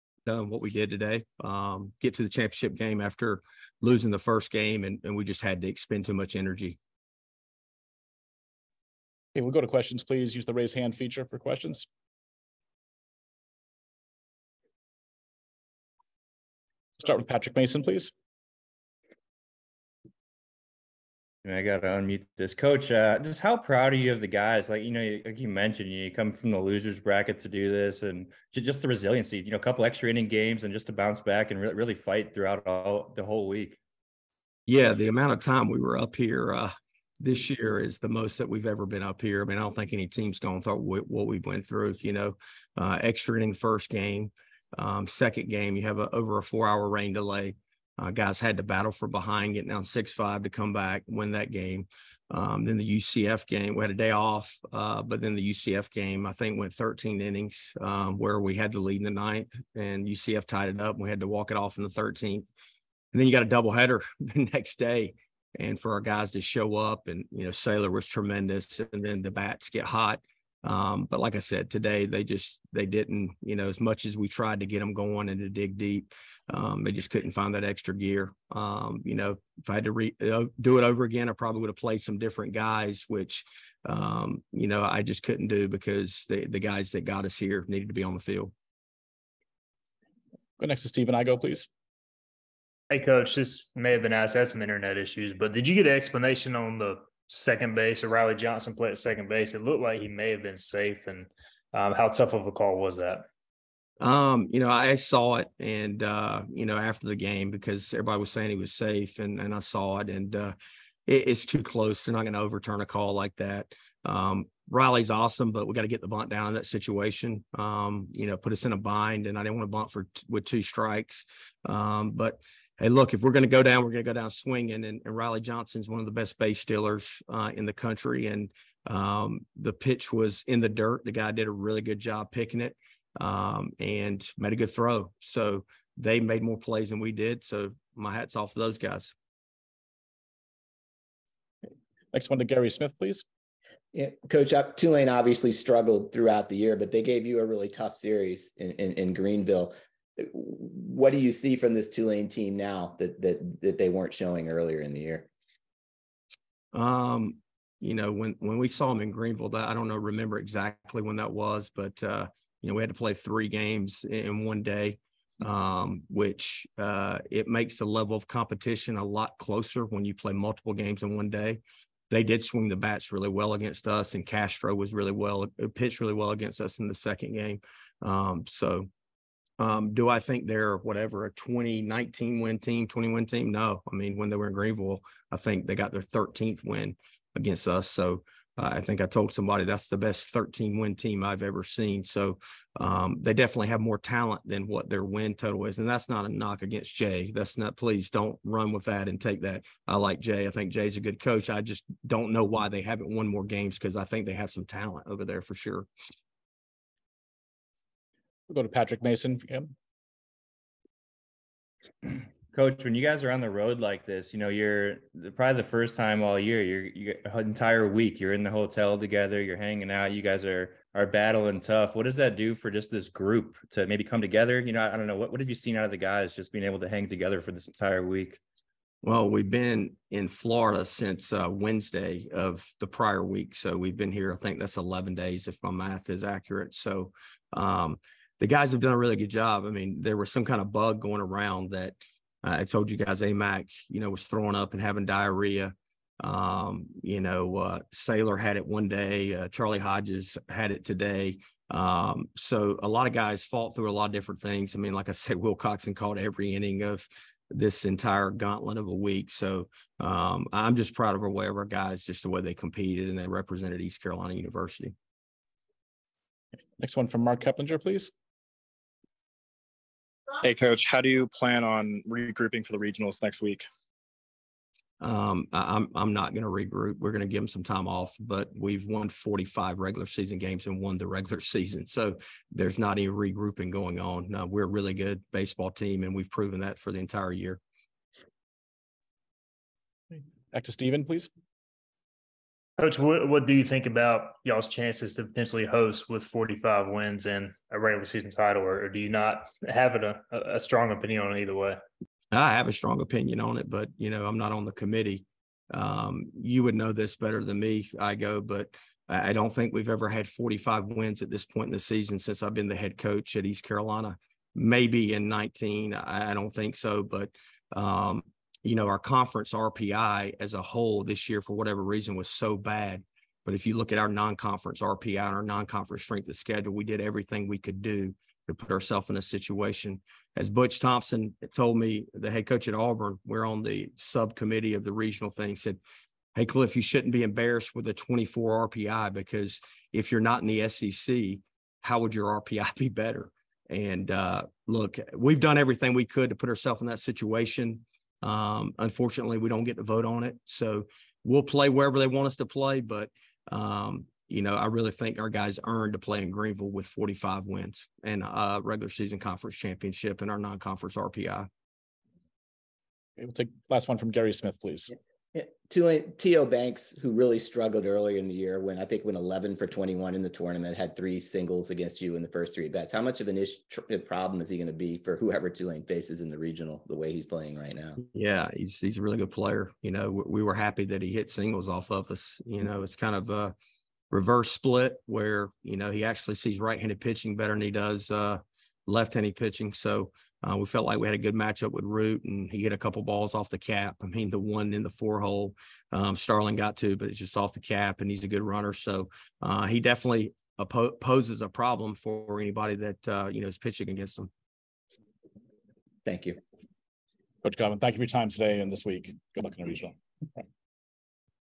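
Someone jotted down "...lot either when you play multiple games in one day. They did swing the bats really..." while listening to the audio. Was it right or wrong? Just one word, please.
wrong.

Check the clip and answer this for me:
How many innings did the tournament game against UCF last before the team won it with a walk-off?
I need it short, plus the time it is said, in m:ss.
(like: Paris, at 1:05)
13, at 0:56.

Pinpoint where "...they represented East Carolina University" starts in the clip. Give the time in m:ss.
4:23.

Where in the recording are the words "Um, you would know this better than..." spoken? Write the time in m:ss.
5:05.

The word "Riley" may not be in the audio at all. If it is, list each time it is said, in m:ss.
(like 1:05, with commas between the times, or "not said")
1:38, 1:54, 2:05.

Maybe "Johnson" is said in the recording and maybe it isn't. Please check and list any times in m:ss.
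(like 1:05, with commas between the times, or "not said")
1:38, 2:05.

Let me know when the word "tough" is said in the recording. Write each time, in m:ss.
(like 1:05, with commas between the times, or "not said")
1:42, 2:27, 3:41.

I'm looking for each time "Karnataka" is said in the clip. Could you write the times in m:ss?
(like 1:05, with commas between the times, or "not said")
not said.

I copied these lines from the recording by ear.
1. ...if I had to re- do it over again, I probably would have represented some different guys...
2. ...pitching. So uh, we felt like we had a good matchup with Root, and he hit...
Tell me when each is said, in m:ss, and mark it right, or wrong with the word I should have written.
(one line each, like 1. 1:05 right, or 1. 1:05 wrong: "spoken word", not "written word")
1. 1:19 wrong: "played", not "represented"
2. 6:29 right.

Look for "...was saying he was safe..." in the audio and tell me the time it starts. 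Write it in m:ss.
1:48.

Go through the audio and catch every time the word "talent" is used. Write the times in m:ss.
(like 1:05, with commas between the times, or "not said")
3:13, 3:24.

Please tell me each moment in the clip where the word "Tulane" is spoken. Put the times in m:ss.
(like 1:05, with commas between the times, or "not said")
2:24, 2:31, 6:15.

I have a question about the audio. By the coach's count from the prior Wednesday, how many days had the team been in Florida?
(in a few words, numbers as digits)
11.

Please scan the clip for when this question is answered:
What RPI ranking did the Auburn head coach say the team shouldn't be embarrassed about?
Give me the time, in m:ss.
5:37.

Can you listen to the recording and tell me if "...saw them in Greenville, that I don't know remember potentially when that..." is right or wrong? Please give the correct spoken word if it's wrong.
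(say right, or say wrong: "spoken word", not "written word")
wrong: "exactly", not "potentially".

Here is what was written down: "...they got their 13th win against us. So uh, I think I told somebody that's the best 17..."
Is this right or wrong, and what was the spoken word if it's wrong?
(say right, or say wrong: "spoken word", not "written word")
wrong: "13", not "17".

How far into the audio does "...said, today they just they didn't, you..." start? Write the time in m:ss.
1:11.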